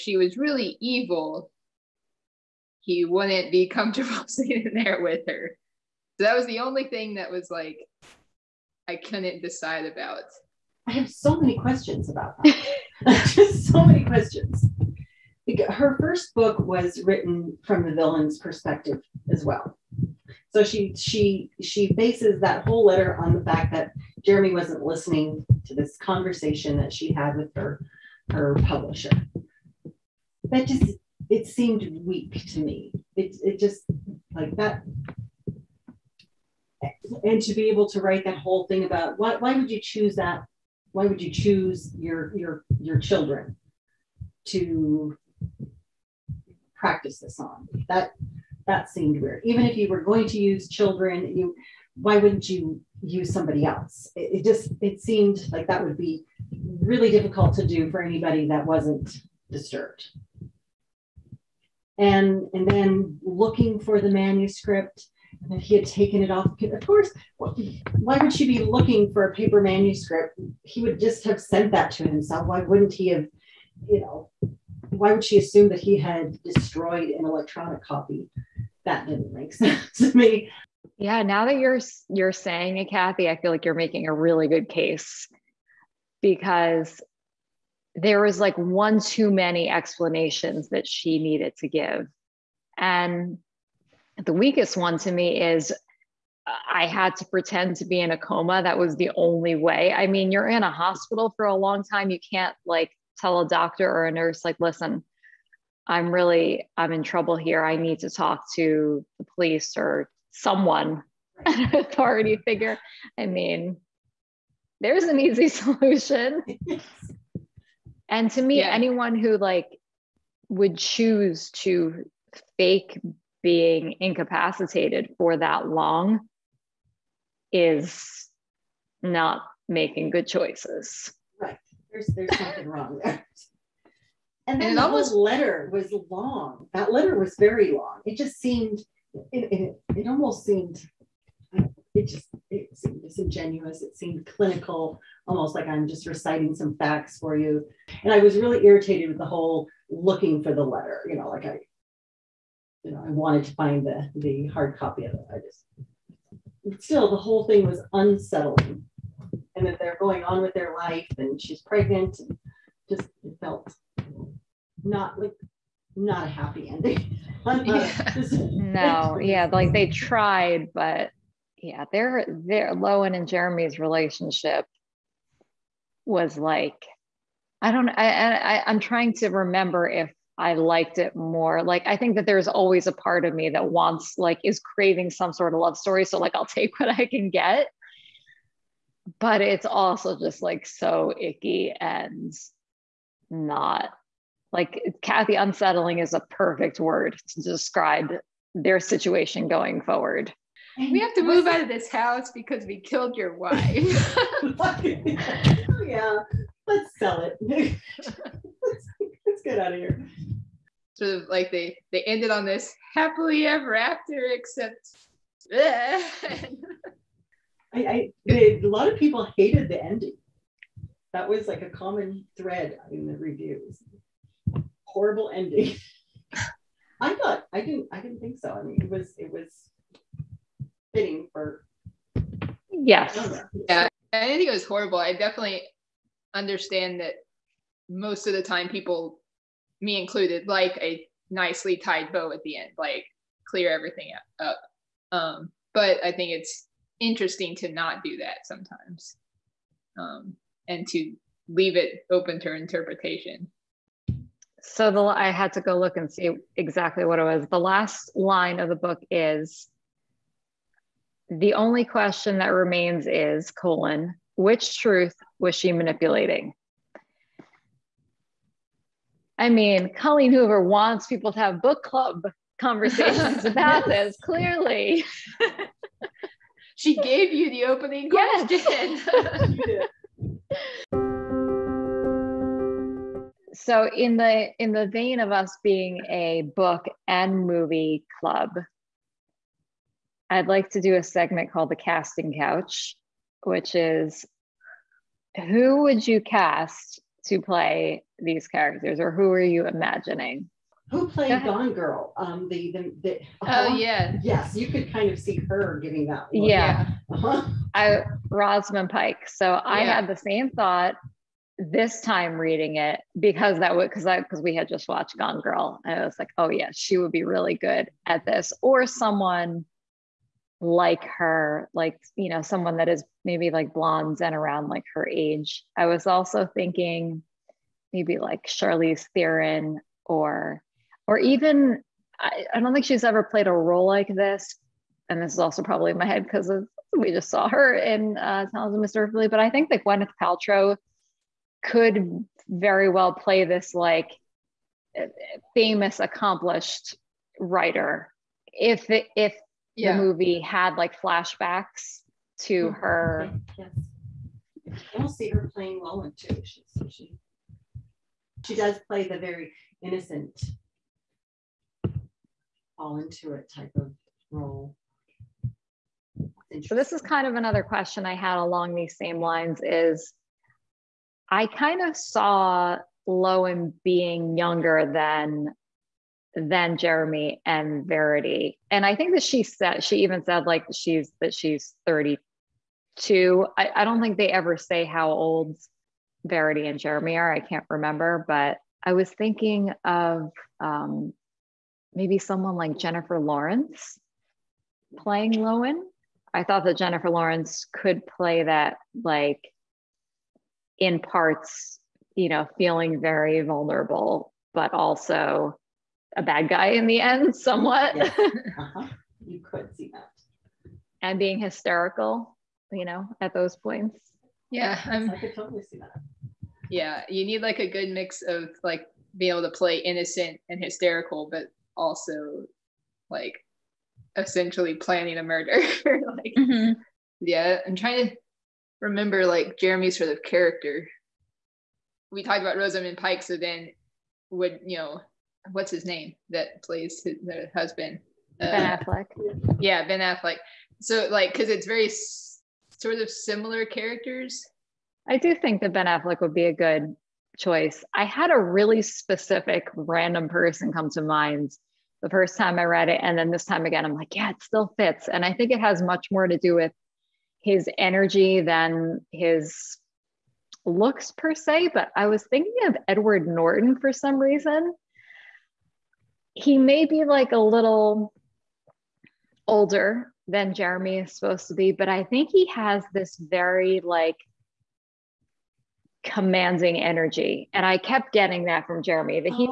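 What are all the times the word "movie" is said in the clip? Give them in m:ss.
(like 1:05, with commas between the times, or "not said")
4:47, 5:50.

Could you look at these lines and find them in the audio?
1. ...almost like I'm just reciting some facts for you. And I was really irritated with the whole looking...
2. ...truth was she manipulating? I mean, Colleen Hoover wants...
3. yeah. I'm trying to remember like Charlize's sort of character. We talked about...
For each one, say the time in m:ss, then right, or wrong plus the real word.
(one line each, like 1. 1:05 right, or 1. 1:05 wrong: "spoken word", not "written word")
1. 2:25 right
2. 4:24 right
3. 7:07 wrong: "Jeremy", not "Charlize".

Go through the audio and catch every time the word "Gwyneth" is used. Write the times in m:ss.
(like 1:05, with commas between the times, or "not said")
5:39.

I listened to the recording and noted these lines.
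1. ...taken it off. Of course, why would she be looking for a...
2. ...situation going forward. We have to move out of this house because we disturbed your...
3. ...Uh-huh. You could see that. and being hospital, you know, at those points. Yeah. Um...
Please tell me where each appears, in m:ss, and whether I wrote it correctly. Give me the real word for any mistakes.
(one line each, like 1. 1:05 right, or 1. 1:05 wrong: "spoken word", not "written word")
1. 1:05 right
2. 3:18 wrong: "killed", not "disturbed"
3. 6:48 wrong: "hysterical", not "hospital".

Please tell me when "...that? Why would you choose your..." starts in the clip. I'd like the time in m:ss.
0:40.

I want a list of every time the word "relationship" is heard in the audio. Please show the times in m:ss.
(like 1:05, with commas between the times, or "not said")
2:53.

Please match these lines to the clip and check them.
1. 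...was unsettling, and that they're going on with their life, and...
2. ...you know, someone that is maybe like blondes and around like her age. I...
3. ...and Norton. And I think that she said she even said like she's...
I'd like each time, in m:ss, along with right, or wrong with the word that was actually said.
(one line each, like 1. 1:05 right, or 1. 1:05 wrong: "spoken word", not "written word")
1. 2:37 right
2. 5:22 right
3. 6:17 wrong: "Verity", not "Norton".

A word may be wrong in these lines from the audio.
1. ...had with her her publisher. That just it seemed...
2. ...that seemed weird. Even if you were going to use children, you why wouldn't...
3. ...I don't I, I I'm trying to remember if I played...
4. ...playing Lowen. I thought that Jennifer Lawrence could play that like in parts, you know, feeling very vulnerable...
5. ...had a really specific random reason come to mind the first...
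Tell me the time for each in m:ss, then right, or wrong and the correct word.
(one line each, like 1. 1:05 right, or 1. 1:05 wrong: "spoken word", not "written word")
1. 0:27 right
2. 0:48 right
3. 2:57 wrong: "liked", not "played"
4. 6:34 right
5. 7:28 wrong: "person", not "reason".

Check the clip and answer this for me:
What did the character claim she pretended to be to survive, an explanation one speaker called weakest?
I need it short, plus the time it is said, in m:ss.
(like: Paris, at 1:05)
In a coma, at 1:38.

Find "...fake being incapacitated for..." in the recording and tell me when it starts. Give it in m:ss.
2:02.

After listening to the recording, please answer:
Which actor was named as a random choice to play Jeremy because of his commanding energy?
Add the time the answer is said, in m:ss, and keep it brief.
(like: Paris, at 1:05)
Edward Norton, at 7:42.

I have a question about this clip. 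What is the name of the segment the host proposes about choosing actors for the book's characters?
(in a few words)
The casting couch.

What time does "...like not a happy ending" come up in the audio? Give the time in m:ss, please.
2:45.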